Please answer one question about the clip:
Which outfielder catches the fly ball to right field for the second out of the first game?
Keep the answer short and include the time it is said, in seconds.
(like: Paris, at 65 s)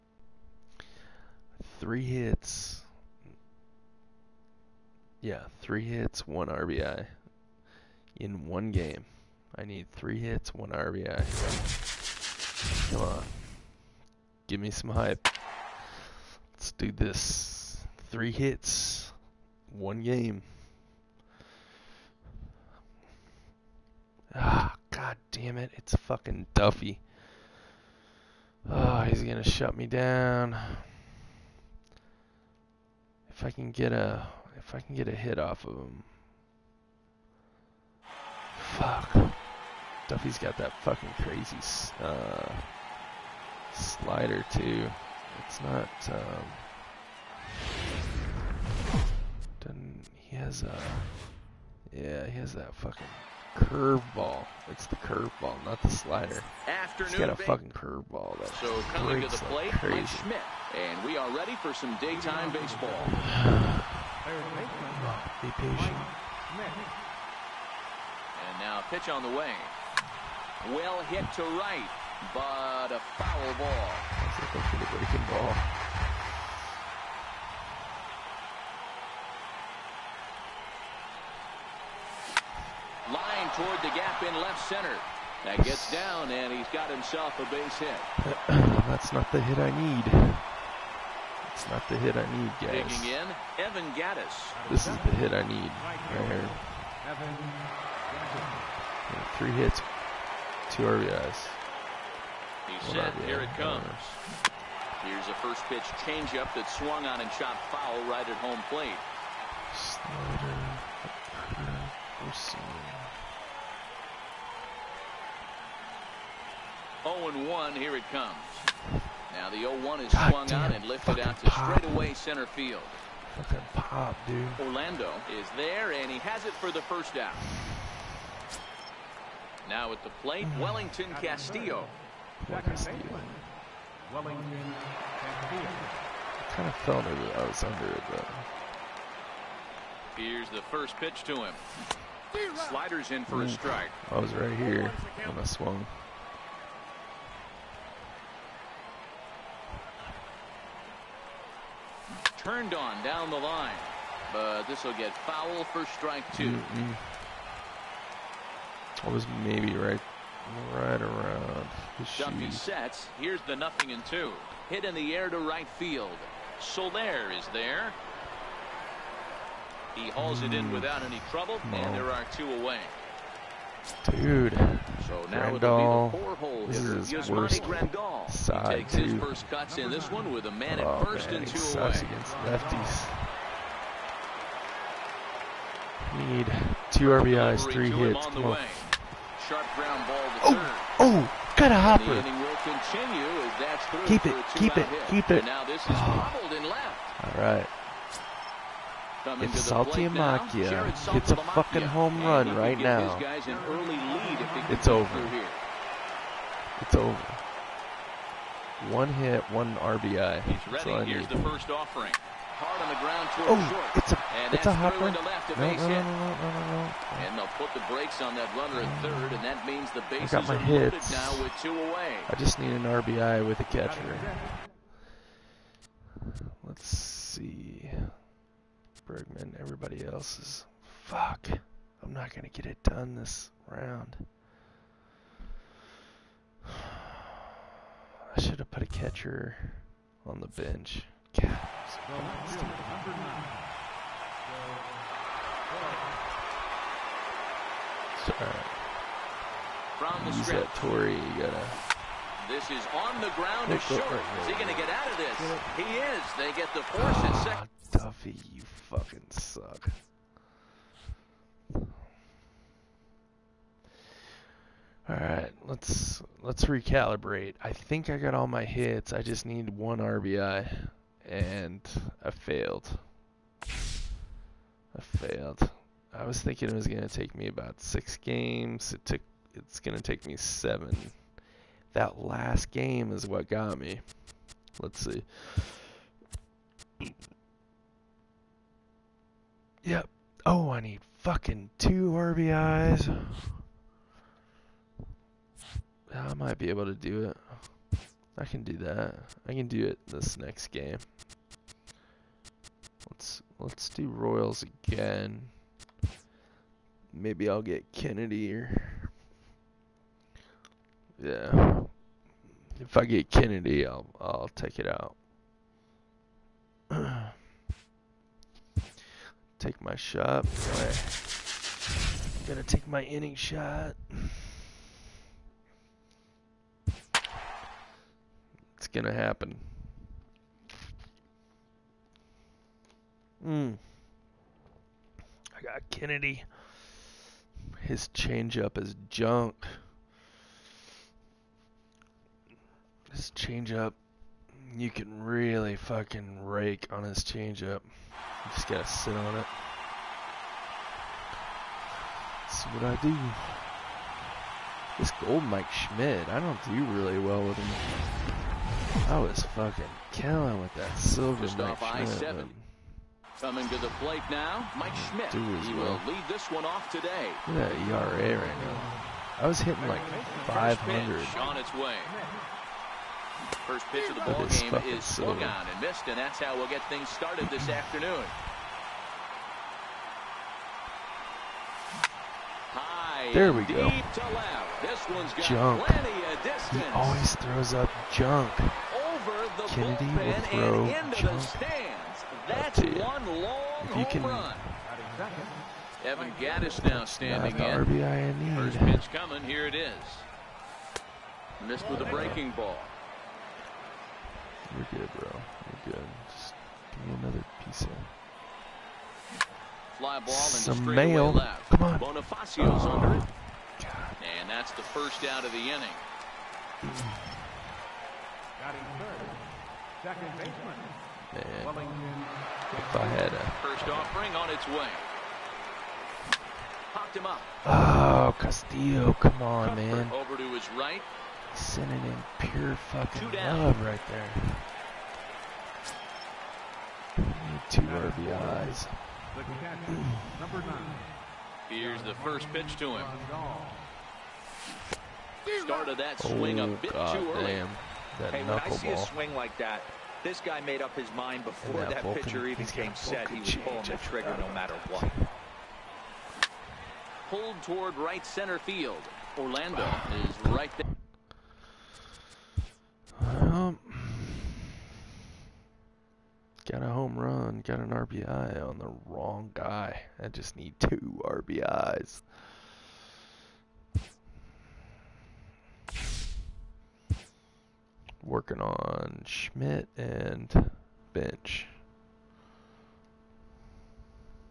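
Soler, at 166 s.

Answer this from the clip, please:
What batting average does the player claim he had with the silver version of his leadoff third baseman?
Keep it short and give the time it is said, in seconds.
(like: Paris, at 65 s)
500, at 370 s.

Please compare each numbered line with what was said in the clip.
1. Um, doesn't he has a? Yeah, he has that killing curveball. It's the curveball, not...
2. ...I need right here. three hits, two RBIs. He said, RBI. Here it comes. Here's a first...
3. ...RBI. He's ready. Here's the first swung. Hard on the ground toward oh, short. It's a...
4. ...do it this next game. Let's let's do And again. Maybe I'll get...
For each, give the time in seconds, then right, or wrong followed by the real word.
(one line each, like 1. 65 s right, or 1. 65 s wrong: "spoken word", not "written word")
1. 46 s wrong: "fucking", not "killing"
2. 95 s right
3. 209 s wrong: "offering", not "swung"
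4. 299 s wrong: "Royals", not "And".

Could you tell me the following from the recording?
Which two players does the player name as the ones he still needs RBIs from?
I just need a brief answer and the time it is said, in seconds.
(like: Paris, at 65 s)
Schmidt and Bench, at 479 s.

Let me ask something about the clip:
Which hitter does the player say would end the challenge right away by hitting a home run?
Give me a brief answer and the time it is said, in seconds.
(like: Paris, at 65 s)
Saltalamacchia, at 199 s.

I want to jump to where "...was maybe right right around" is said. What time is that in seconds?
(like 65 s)
159 s.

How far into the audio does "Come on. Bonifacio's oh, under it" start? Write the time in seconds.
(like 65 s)
411 s.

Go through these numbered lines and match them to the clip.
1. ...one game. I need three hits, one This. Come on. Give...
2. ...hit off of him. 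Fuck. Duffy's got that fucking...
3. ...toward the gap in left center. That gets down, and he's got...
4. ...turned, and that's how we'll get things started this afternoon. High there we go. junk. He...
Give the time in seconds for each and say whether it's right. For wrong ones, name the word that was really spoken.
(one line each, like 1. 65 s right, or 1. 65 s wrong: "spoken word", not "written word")
1. 8 s wrong: "RBI", not "This"
2. 35 s right
3. 83 s right
4. 375 s wrong: "missed", not "turned".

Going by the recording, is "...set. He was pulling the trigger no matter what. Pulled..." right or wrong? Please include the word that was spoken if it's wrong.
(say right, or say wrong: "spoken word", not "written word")
right.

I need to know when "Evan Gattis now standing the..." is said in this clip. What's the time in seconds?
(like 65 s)
396 s.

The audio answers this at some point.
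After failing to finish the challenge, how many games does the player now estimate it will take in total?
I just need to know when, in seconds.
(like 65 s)
280 s.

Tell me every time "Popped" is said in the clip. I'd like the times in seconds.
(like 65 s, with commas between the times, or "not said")
426 s.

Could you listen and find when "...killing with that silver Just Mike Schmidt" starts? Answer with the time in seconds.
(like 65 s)
360 s.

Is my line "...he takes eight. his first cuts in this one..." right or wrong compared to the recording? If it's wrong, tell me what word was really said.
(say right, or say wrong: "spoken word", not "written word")
wrong: "two", not "eight".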